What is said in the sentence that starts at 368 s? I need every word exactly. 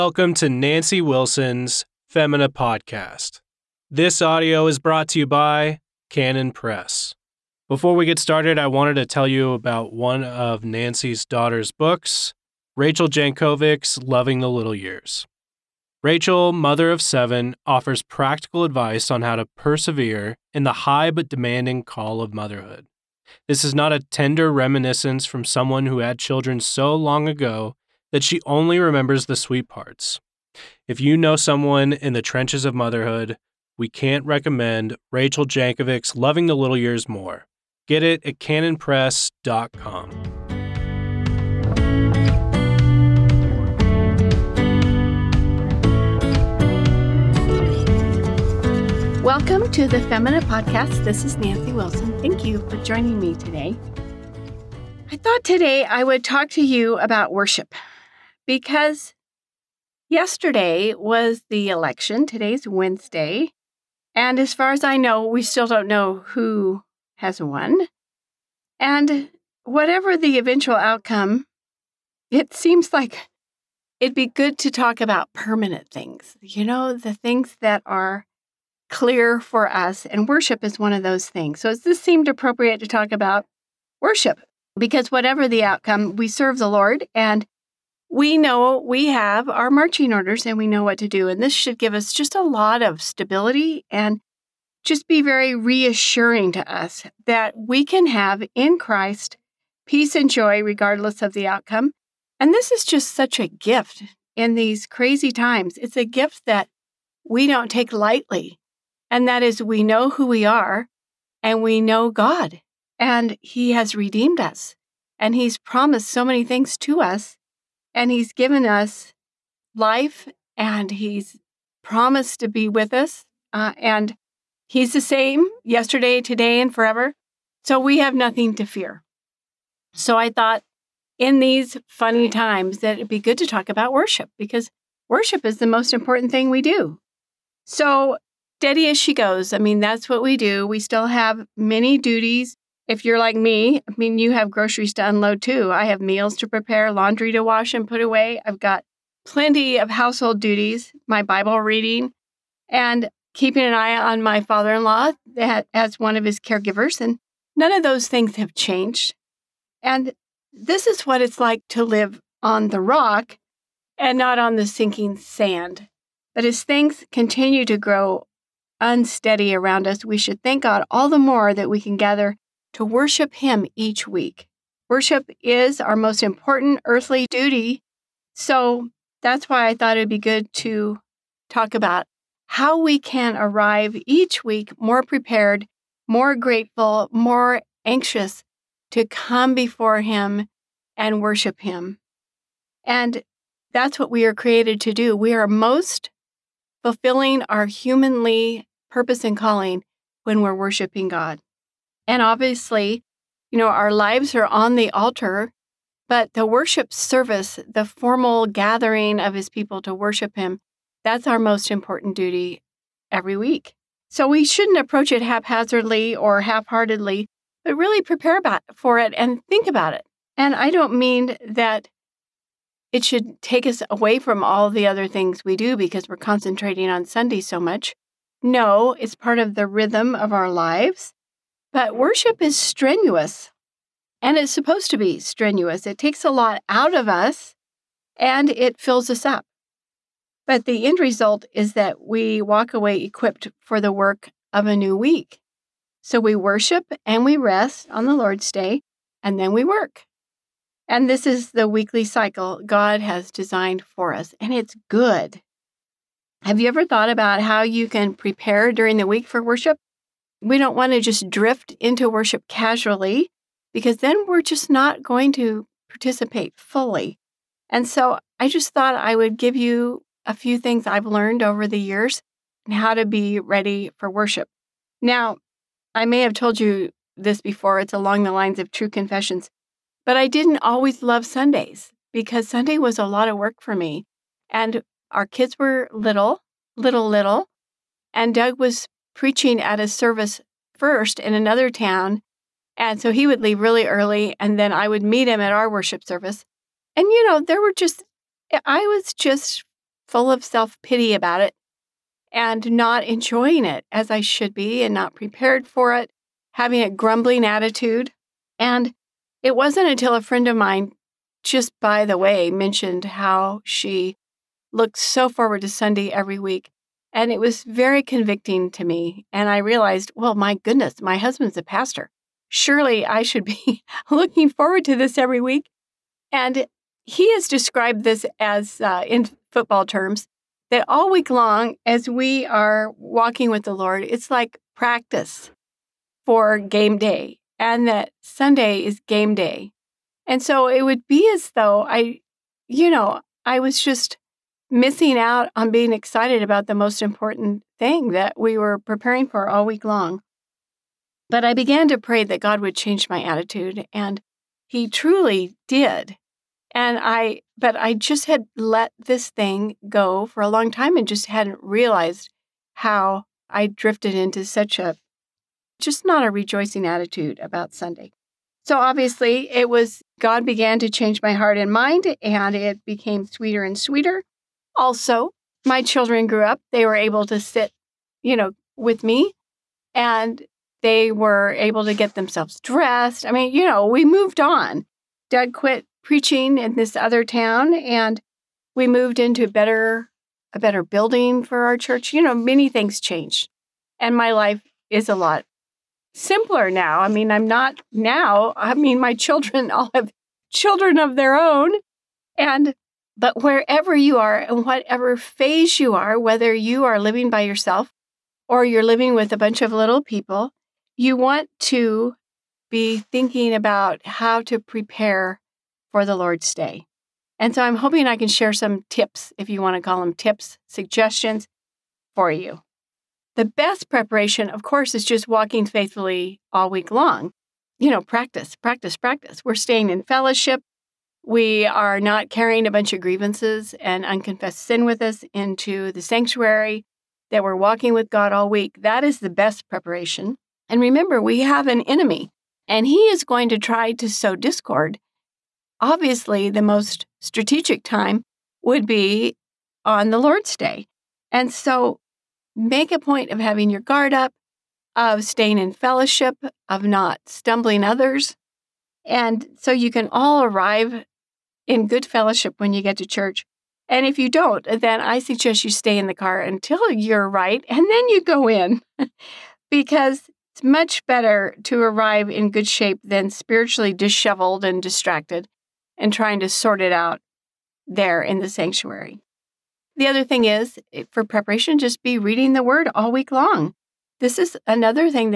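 So obviously, it was God began to change my heart and mind, and it became sweeter and sweeter.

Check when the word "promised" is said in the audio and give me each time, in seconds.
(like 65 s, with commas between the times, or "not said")
115 s, 121 s.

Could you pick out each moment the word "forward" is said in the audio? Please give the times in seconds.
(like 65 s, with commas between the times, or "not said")
315 s, 324 s.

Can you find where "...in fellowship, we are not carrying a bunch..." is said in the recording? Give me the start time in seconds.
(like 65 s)
429 s.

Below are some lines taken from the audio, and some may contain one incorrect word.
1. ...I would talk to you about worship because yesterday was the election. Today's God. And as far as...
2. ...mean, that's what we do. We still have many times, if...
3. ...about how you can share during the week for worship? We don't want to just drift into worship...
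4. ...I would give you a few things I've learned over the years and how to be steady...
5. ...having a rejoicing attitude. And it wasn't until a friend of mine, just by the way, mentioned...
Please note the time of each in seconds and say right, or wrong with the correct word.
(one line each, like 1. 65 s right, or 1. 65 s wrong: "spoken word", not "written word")
1. 55 s wrong: "Wednesday", not "God"
2. 139 s wrong: "duties", not "times"
3. 257 s wrong: "prepare", not "share"
4. 268 s wrong: "ready", not "steady"
5. 306 s wrong: "grumbling", not "rejoicing".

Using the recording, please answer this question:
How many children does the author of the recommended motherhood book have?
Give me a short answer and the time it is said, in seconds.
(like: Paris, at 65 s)
7, at 17 s.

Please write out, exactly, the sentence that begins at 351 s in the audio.
But I began to pray that God would change my attitude, and He truly did.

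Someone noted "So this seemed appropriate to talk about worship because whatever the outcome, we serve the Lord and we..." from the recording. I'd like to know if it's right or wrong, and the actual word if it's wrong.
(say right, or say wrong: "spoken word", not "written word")
right.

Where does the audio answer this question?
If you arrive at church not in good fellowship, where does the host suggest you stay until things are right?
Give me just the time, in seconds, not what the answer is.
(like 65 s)
466 s.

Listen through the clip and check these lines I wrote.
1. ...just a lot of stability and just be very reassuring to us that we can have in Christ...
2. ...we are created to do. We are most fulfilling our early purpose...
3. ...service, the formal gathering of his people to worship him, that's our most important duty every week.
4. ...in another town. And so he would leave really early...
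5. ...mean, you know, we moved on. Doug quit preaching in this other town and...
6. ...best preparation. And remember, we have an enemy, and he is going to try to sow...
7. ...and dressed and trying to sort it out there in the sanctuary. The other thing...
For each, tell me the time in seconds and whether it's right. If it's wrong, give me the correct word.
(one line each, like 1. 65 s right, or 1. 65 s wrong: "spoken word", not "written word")
1. 92 s right
2. 194 s wrong: "humanly", not "early"
3. 206 s right
4. 291 s right
5. 383 s right
6. 439 s right
7. 474 s wrong: "distracted", not "dressed".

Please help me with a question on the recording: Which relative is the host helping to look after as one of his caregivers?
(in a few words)
father in law.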